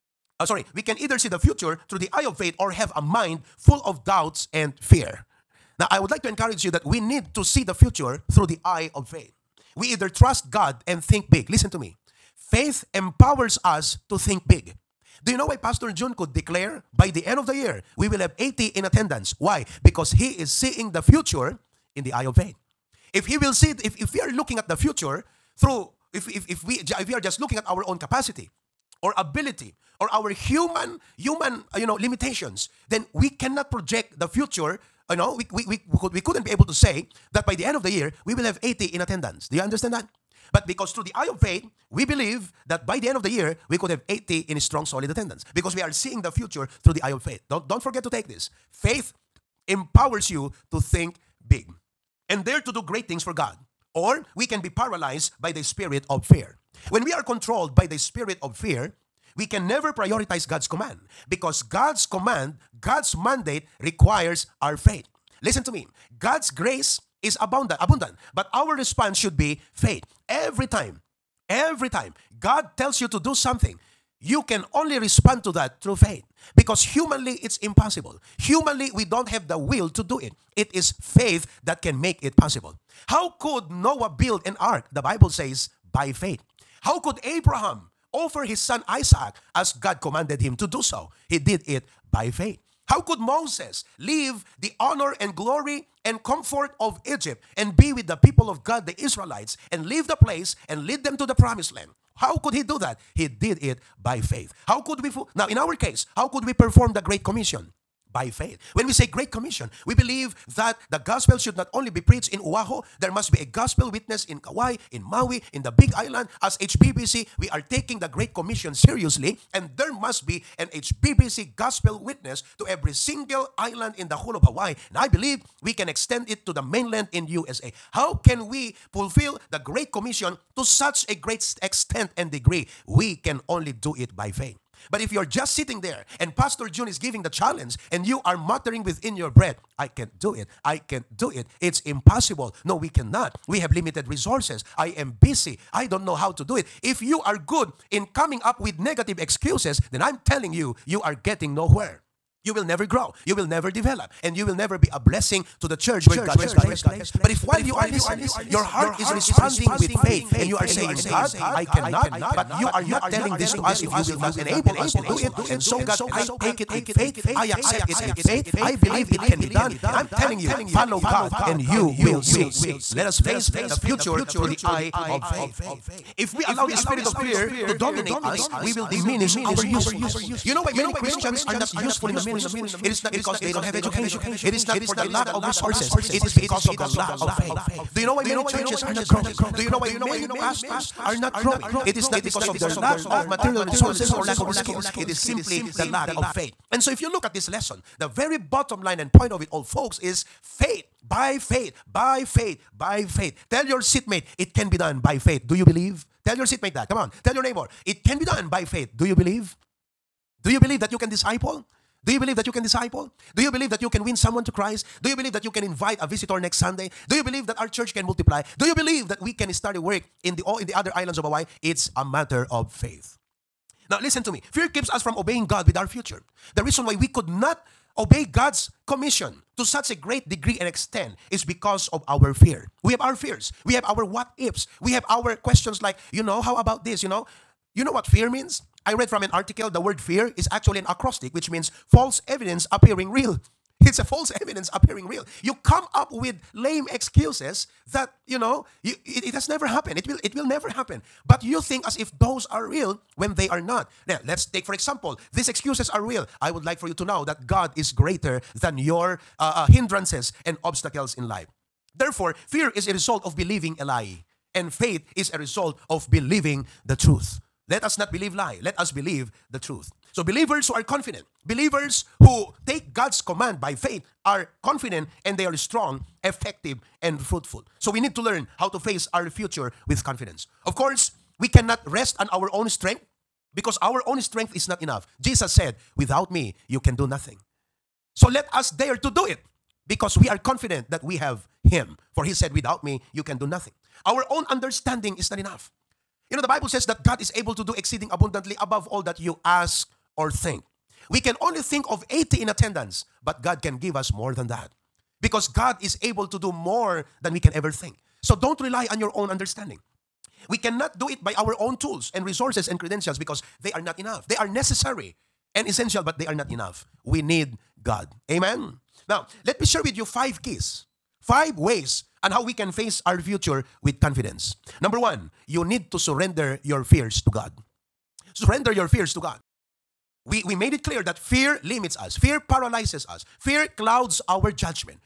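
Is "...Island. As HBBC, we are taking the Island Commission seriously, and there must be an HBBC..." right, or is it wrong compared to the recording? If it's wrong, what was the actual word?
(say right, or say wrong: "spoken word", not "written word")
wrong: "Great", not "Island".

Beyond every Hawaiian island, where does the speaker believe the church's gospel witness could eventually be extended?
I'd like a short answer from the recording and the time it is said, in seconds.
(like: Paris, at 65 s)
the mainland, at 126 s.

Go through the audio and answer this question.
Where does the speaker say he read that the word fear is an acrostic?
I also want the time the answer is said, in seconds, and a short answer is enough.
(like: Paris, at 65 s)
an article, at 239 s.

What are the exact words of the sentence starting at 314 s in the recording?
They are necessary and essential, but they are not enough.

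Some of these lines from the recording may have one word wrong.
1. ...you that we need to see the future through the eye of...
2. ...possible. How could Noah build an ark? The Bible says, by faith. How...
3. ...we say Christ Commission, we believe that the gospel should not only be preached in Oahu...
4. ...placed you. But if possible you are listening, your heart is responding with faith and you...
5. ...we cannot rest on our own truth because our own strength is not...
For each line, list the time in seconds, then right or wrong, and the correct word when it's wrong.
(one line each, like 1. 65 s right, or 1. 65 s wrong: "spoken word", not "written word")
1. 6 s right
2. 82 s right
3. 108 s wrong: "Great", not "Christ"
4. 156 s wrong: "while", not "possible"
5. 281 s wrong: "strength", not "truth".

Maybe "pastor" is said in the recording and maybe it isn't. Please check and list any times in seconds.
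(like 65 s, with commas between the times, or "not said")
15 s, 136 s, 190 s.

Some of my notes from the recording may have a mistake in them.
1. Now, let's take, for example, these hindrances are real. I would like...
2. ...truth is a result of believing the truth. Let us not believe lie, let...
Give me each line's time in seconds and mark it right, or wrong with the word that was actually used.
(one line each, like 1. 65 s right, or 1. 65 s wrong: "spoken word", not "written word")
1. 254 s wrong: "excuses", not "hindrances"
2. 264 s wrong: "faith", not "truth".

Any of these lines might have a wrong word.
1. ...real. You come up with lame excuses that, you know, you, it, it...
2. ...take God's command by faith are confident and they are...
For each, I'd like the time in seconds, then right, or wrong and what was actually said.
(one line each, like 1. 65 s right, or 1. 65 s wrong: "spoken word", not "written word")
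1. 245 s right
2. 272 s right.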